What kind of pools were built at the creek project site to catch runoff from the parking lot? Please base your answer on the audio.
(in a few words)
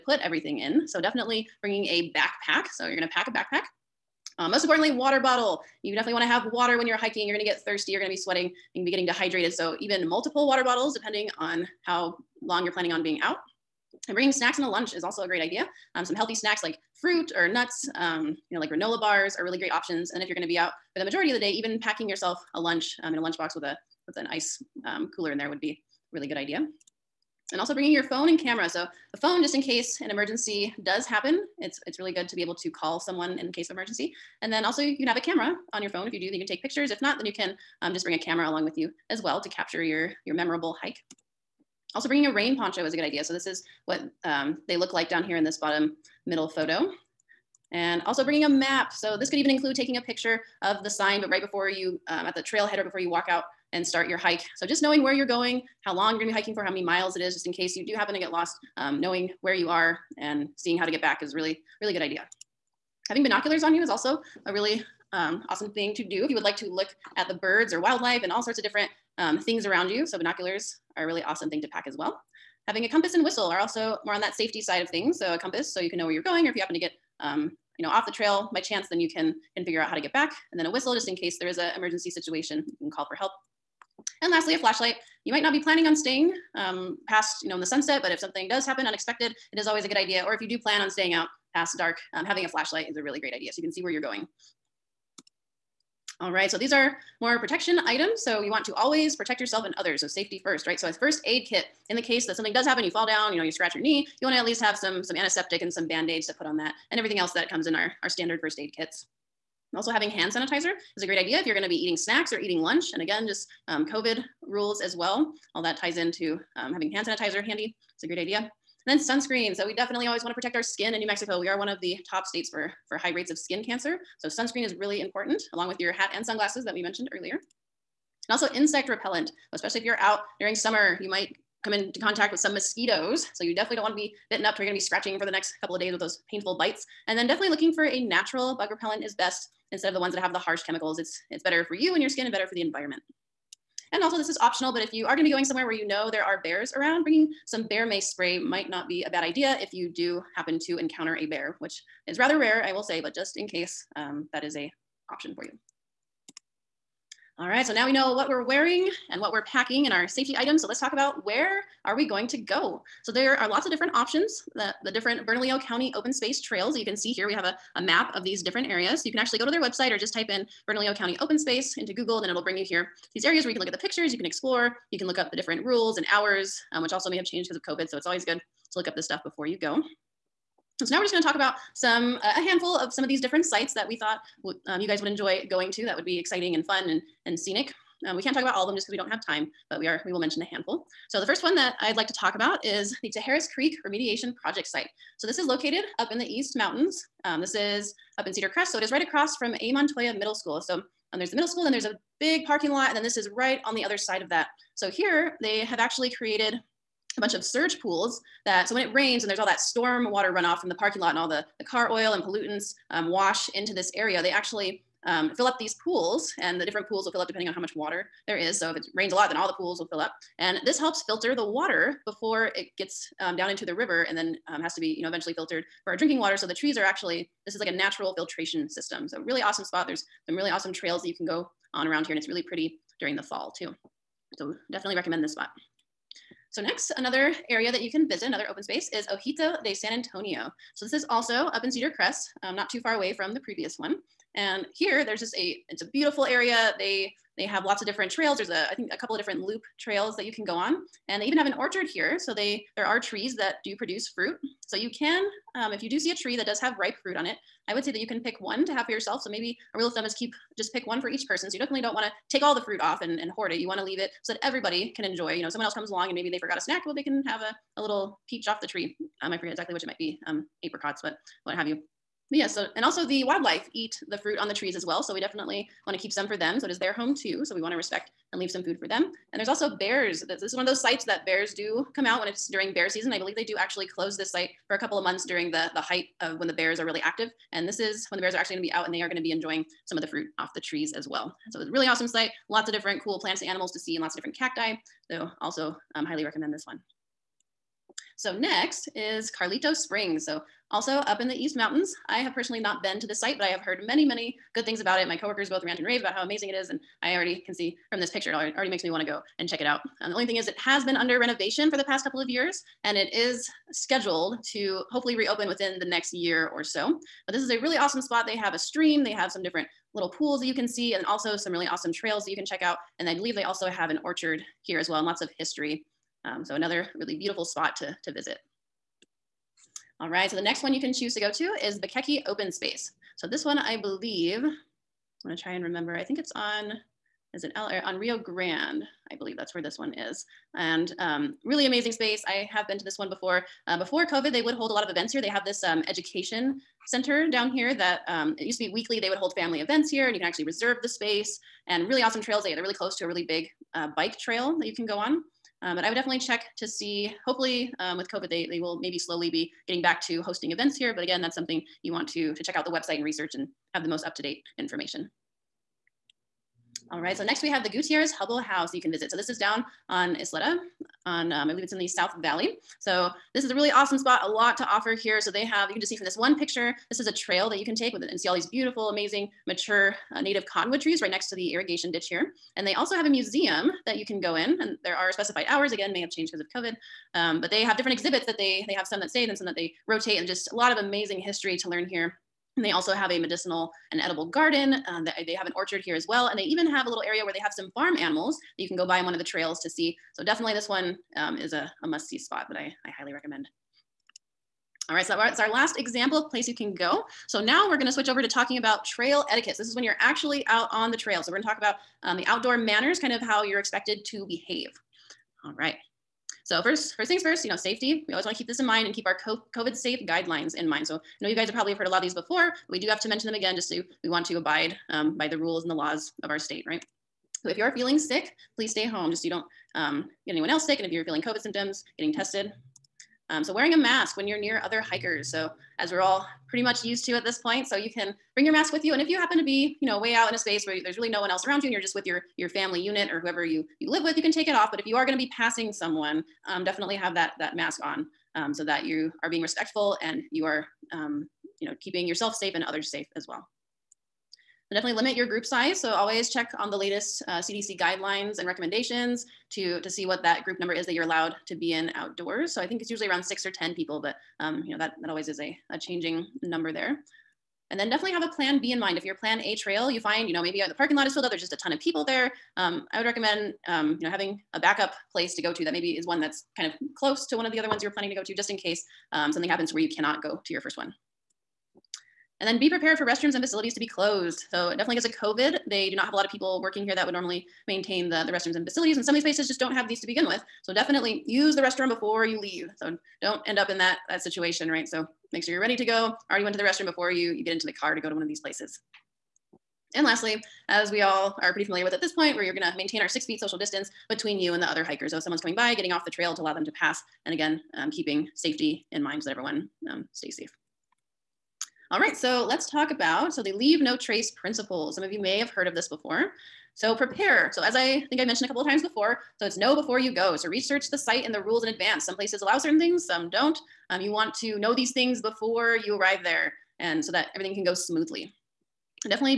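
surge pools.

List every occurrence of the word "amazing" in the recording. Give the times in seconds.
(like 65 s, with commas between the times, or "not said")
306 s, 341 s, 378 s, 390 s.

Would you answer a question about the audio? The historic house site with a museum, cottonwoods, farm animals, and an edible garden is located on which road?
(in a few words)
Isleta.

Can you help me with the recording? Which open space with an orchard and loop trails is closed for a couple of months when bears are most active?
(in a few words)
Ojito de San Antonio.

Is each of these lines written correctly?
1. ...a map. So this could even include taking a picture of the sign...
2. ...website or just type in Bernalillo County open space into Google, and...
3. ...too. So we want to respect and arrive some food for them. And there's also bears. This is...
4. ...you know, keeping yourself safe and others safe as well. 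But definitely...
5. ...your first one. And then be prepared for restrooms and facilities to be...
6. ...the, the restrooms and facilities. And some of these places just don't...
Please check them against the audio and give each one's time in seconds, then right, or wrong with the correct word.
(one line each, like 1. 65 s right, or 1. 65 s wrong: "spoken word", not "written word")
1. 48 s right
2. 169 s right
3. 277 s wrong: "leave", not "arrive"
4. 451 s right
5. 480 s right
6. 488 s right.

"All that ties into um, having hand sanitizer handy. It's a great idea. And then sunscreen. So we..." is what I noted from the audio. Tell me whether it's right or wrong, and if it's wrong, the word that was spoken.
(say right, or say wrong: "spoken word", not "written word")
right.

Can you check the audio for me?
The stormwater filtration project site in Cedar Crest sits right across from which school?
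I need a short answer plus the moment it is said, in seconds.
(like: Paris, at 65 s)
A. Montoya Middle School, at 199 s.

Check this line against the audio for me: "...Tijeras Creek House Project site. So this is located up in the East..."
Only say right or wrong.
wrong.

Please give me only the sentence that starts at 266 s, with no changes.
Well, they can have a, a little peach off the tree.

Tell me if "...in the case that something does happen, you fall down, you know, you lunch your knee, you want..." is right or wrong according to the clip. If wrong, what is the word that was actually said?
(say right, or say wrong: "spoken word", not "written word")
wrong: "scratch", not "lunch".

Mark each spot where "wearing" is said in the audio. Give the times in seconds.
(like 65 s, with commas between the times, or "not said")
158 s, 433 s.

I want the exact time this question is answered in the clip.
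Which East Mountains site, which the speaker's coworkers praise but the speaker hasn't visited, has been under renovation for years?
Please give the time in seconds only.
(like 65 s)
299 s.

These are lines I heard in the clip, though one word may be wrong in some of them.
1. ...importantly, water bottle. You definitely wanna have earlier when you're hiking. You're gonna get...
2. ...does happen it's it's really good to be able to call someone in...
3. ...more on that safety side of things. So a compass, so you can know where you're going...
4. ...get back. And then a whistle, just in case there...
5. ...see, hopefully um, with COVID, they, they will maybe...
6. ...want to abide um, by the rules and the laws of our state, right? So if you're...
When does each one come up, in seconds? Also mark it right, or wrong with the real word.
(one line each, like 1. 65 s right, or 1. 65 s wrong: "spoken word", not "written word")
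1. 4 s wrong: "water", not "earlier"
2. 30 s right
3. 74 s right
4. 79 s right
5. 356 s right
6. 424 s right.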